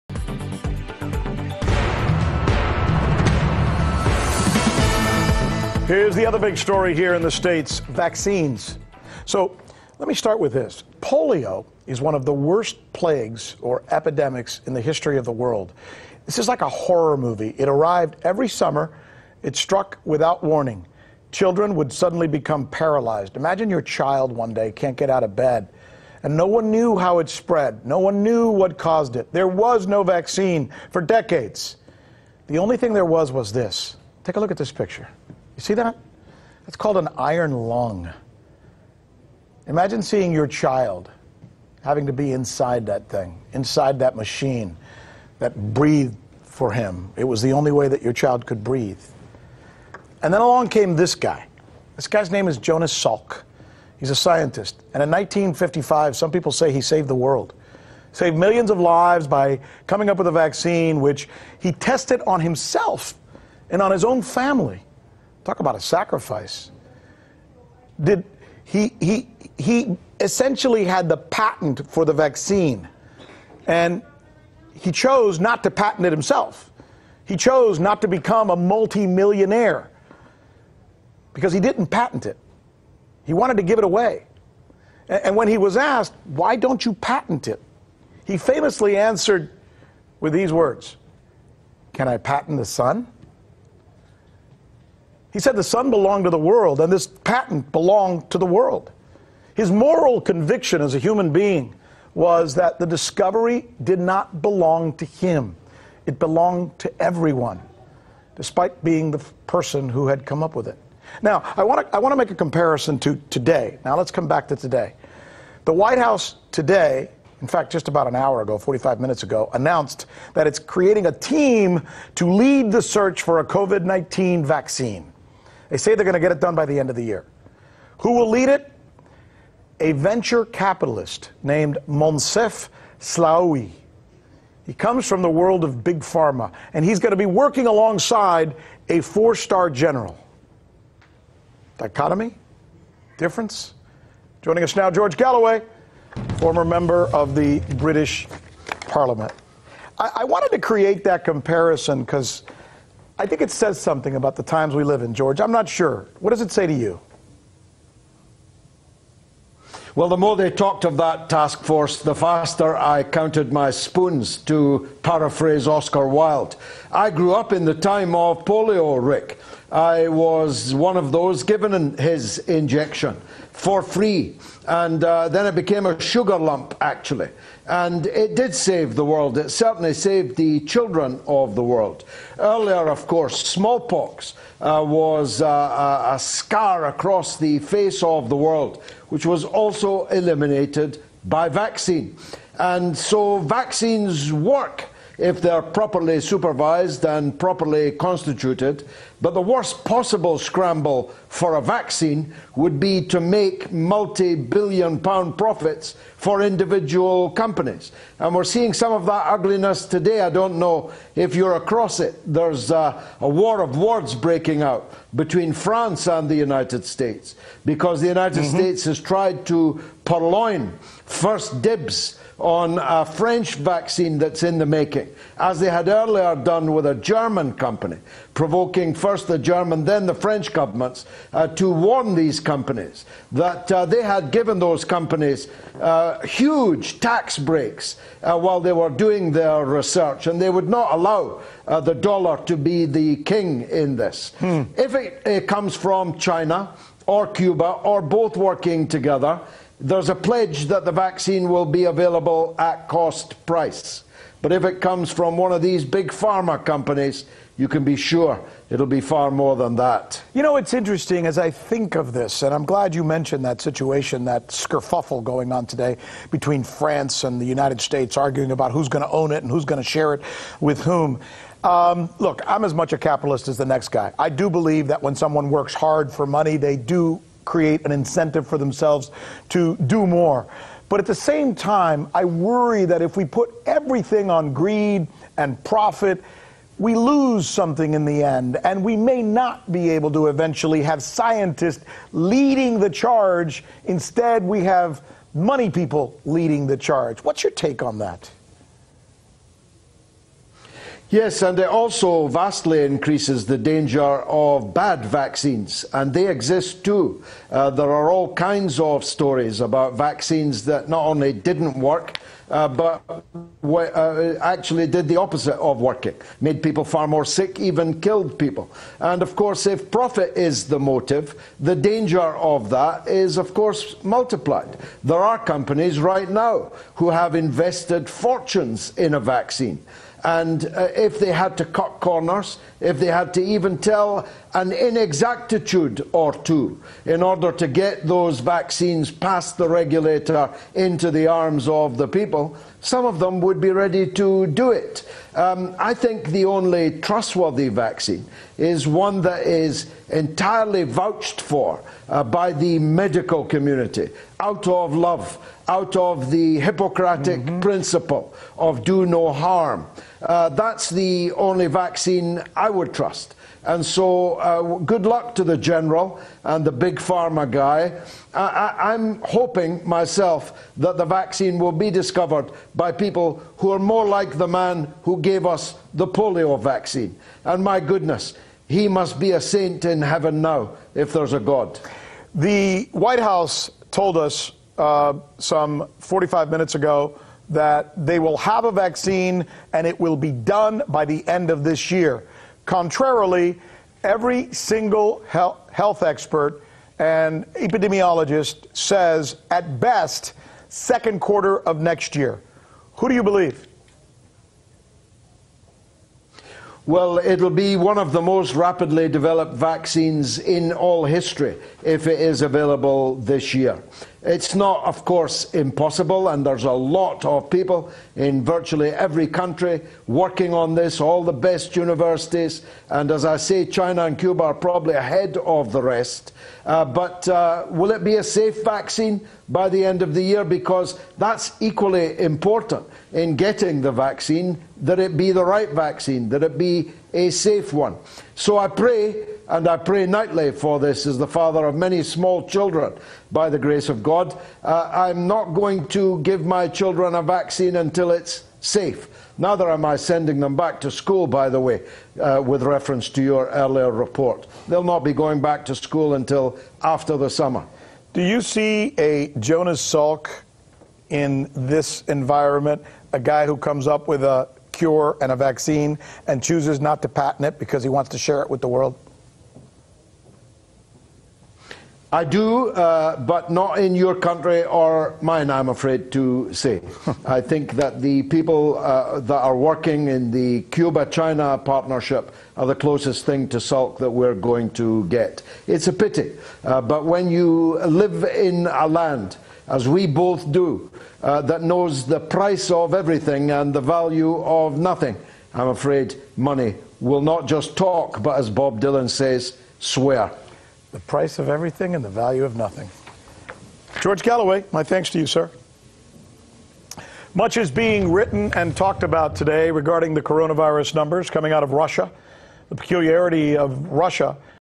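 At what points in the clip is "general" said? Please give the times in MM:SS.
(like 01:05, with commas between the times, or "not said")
02:19, 06:05.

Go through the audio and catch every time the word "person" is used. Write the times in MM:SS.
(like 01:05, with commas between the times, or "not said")
01:49.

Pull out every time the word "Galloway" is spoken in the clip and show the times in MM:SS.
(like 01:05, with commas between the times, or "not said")
02:25, 08:24.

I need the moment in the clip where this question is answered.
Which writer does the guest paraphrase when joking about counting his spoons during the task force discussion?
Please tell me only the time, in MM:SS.
02:45.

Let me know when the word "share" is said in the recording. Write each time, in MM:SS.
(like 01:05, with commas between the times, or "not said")
04:29, 07:48.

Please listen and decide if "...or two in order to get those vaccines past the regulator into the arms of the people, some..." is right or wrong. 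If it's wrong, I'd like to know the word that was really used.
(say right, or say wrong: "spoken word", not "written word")
right.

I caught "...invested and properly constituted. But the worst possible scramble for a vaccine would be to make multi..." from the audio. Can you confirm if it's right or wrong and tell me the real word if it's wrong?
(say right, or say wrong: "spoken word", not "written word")
wrong: "supervised", not "invested".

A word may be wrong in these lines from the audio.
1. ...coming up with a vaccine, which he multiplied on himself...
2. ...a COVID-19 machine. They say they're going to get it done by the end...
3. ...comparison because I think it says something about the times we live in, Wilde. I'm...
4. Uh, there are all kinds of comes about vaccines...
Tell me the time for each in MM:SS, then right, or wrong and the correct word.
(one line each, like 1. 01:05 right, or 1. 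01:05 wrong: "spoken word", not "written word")
1. 00:59 wrong: "tested", not "multiplied"
2. 02:03 wrong: "vaccine", not "machine"
3. 02:31 wrong: "George", not "Wilde"
4. 05:07 wrong: "stories", not "comes".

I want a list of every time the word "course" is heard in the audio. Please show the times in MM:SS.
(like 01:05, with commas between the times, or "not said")
03:03, 05:19, 05:23, 06:55.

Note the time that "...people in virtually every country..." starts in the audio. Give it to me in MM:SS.
06:57.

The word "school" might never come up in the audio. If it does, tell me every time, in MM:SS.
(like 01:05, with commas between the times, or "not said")
07:30, 07:35.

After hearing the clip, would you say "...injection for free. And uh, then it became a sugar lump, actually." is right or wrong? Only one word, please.
right.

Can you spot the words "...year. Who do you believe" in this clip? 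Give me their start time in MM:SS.
06:42.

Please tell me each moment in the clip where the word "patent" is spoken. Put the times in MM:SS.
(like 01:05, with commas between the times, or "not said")
01:11, 01:15, 01:21, 01:26, 01:32, 01:37, 07:47.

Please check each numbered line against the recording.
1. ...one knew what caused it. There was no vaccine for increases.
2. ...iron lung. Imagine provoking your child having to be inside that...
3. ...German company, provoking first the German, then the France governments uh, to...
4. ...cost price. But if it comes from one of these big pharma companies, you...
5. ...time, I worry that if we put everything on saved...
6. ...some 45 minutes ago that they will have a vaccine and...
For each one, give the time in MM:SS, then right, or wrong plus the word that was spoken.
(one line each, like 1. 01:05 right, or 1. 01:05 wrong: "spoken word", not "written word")
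1. 00:27 wrong: "decades", not "increases"
2. 00:37 wrong: "seeing", not "provoking"
3. 03:46 wrong: "French", not "France"
4. 04:12 right
5. 04:41 wrong: "greed", not "saved"
6. 06:25 right.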